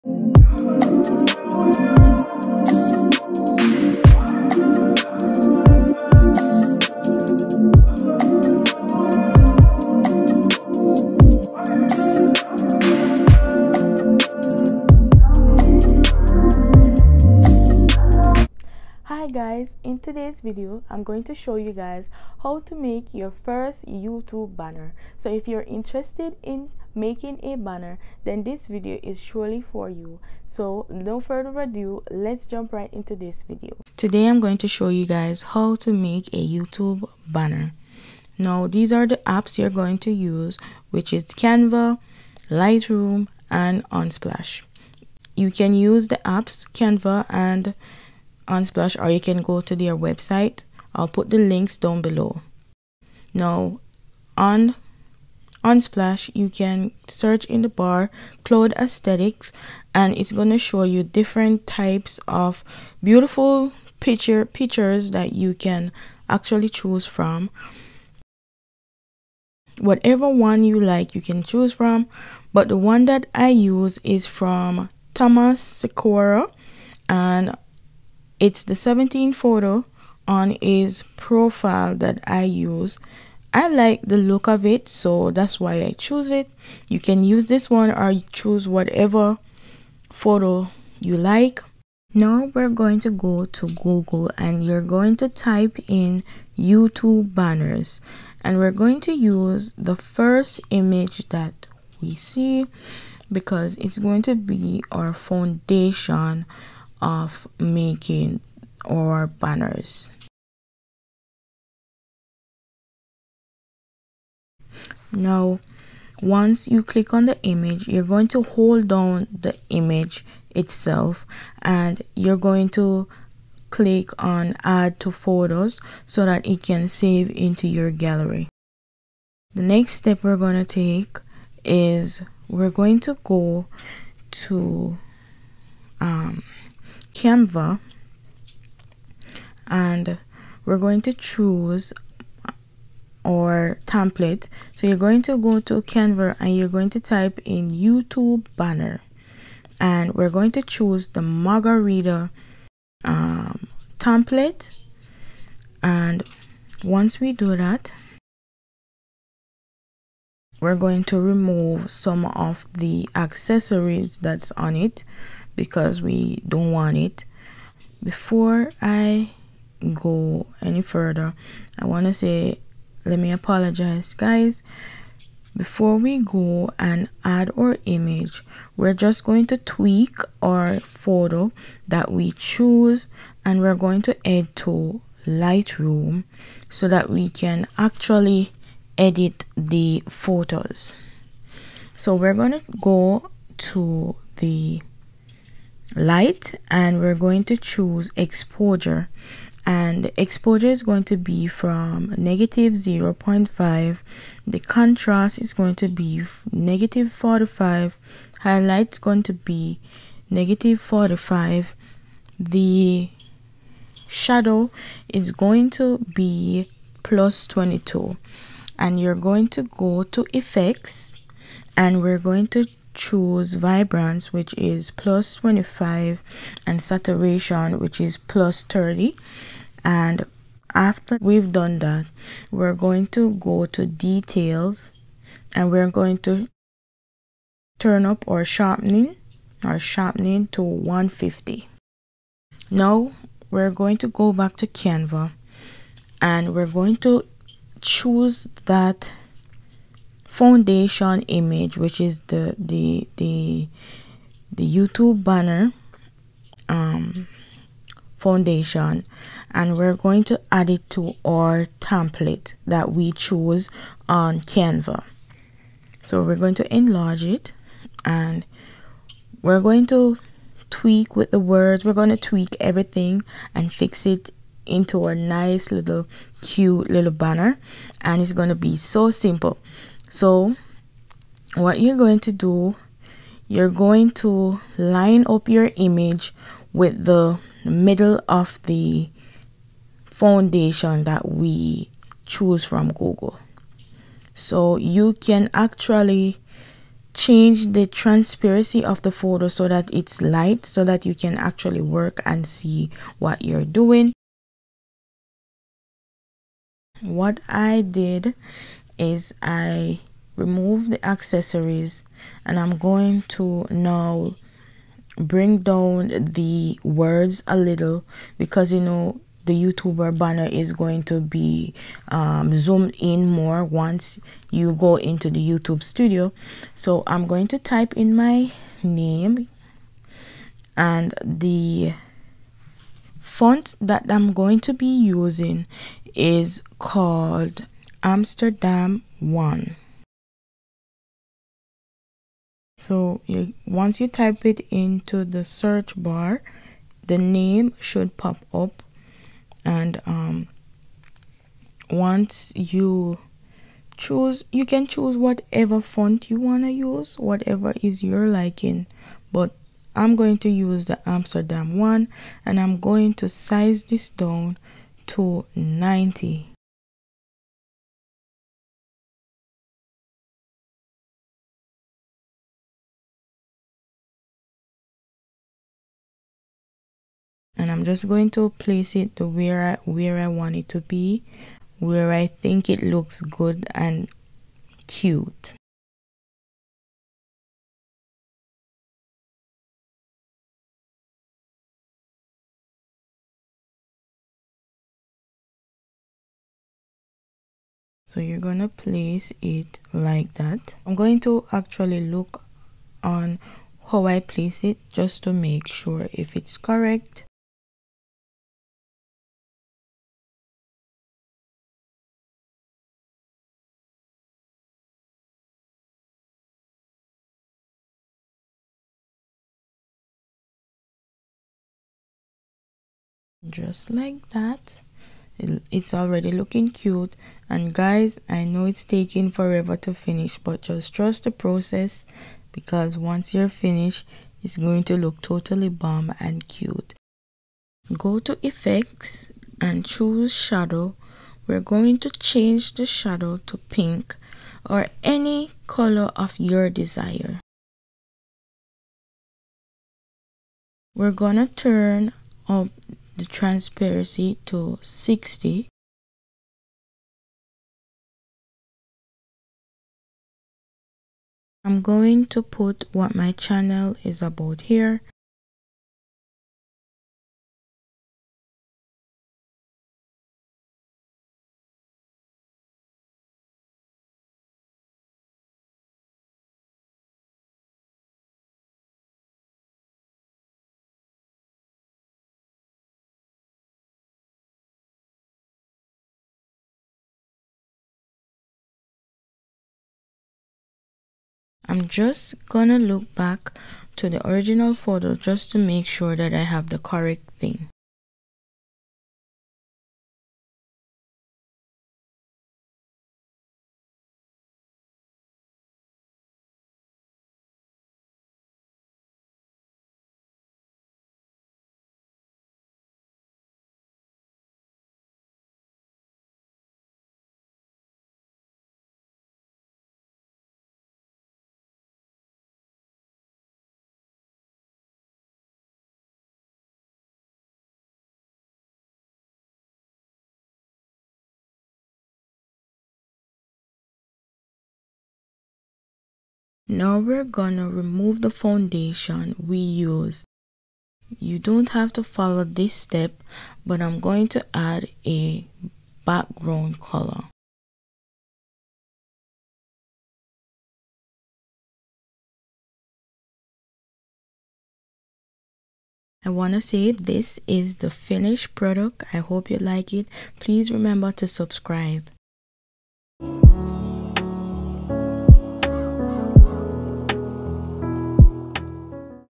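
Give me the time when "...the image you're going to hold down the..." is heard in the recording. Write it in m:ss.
1:57.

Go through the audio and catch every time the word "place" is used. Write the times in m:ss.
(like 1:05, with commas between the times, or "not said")
6:18, 6:38, 6:44.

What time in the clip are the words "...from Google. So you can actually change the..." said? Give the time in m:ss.
4:52.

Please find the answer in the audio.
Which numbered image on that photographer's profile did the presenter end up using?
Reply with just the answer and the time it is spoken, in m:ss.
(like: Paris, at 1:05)
17th, at 1:18.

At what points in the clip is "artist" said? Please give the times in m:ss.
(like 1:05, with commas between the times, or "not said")
not said.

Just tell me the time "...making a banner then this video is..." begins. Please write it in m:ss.
0:26.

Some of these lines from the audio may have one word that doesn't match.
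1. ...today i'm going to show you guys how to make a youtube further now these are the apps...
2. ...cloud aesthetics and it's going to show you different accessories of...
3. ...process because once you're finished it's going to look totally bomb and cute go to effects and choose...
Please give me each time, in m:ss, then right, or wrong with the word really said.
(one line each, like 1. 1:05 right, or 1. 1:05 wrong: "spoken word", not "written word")
1. 0:33 wrong: "banner", not "further"
2. 0:58 wrong: "types", not "accessories"
3. 7:11 right.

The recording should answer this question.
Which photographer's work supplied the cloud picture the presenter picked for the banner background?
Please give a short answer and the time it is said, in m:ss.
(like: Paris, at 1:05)
Thomas Sikora, at 1:15.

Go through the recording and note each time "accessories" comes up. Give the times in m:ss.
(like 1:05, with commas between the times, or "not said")
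2:43, 5:11.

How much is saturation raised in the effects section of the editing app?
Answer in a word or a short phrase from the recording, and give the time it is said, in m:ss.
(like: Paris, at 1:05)
+30, at 3:48.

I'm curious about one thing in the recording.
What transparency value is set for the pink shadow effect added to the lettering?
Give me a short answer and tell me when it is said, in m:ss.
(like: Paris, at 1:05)
60, at 7:34.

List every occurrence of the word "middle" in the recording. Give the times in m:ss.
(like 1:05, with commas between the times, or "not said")
4:47.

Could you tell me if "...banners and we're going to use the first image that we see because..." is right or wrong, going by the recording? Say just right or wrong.
right.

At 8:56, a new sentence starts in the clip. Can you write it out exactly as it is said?
Now we're gonna remove the foundation we used.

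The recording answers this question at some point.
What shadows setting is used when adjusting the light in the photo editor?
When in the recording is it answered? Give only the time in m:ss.
3:37.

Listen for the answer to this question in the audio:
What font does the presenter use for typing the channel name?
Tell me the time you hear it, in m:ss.
5:38.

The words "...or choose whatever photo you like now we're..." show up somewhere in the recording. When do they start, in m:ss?
1:27.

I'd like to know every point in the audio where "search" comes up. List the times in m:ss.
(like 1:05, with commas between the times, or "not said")
0:57, 5:45.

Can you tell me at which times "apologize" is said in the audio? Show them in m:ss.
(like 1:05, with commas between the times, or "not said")
2:53.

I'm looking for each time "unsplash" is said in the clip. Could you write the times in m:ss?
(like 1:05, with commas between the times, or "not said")
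0:43, 0:48, 0:55.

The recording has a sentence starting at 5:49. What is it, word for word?
And um, once you choose, you can choose whatever font you want to use, whatever is your liking.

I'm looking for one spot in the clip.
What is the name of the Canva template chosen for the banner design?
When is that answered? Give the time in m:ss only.
2:31.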